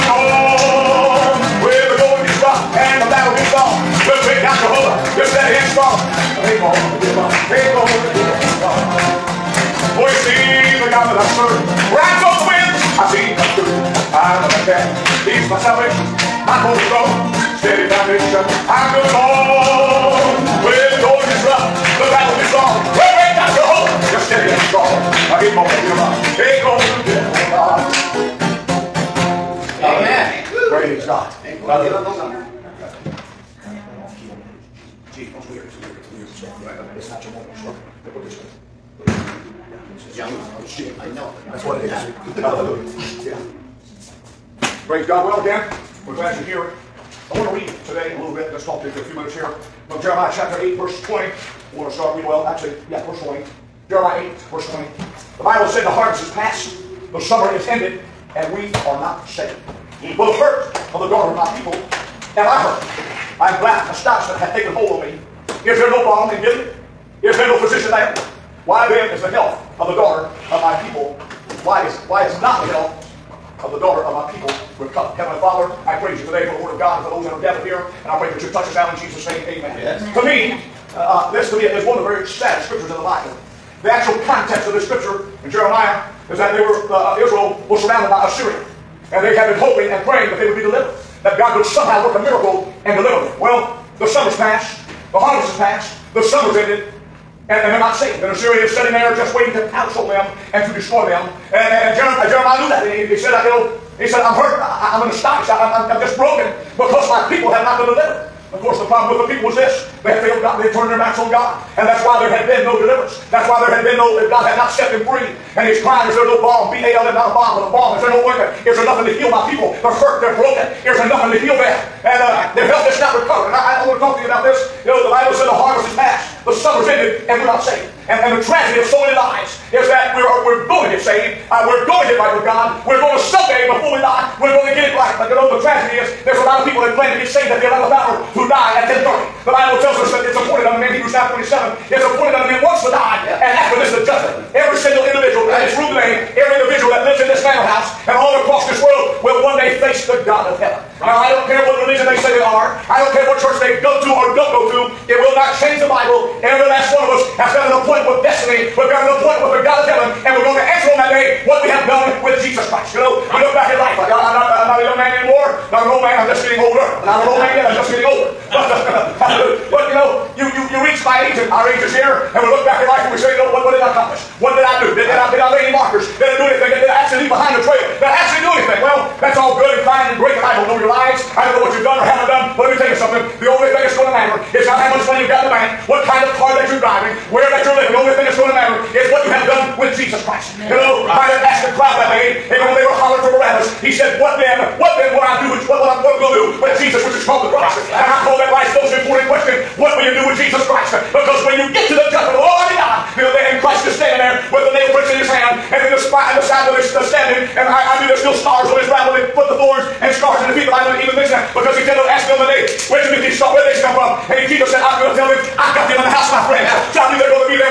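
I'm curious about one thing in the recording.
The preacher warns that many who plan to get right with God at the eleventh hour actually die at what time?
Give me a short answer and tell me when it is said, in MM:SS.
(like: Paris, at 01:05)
10:30, at 02:18.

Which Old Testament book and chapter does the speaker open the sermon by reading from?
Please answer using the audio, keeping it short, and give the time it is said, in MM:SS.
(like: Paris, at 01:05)
Jeremiah 8, at 00:53.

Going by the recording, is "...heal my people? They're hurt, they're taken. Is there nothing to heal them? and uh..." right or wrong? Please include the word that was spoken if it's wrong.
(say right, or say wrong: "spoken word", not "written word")
wrong: "broken", not "taken".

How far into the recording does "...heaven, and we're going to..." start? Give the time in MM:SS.
02:39.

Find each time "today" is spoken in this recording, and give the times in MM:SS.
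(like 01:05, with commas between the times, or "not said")
00:47, 01:16, 02:25.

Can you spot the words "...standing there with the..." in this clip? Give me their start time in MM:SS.
03:23.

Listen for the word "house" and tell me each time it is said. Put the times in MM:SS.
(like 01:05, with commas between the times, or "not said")
02:27, 03:36.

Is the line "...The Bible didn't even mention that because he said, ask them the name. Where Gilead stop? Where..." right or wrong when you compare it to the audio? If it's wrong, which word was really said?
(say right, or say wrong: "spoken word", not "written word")
wrong: "Timothy", not "Gilead".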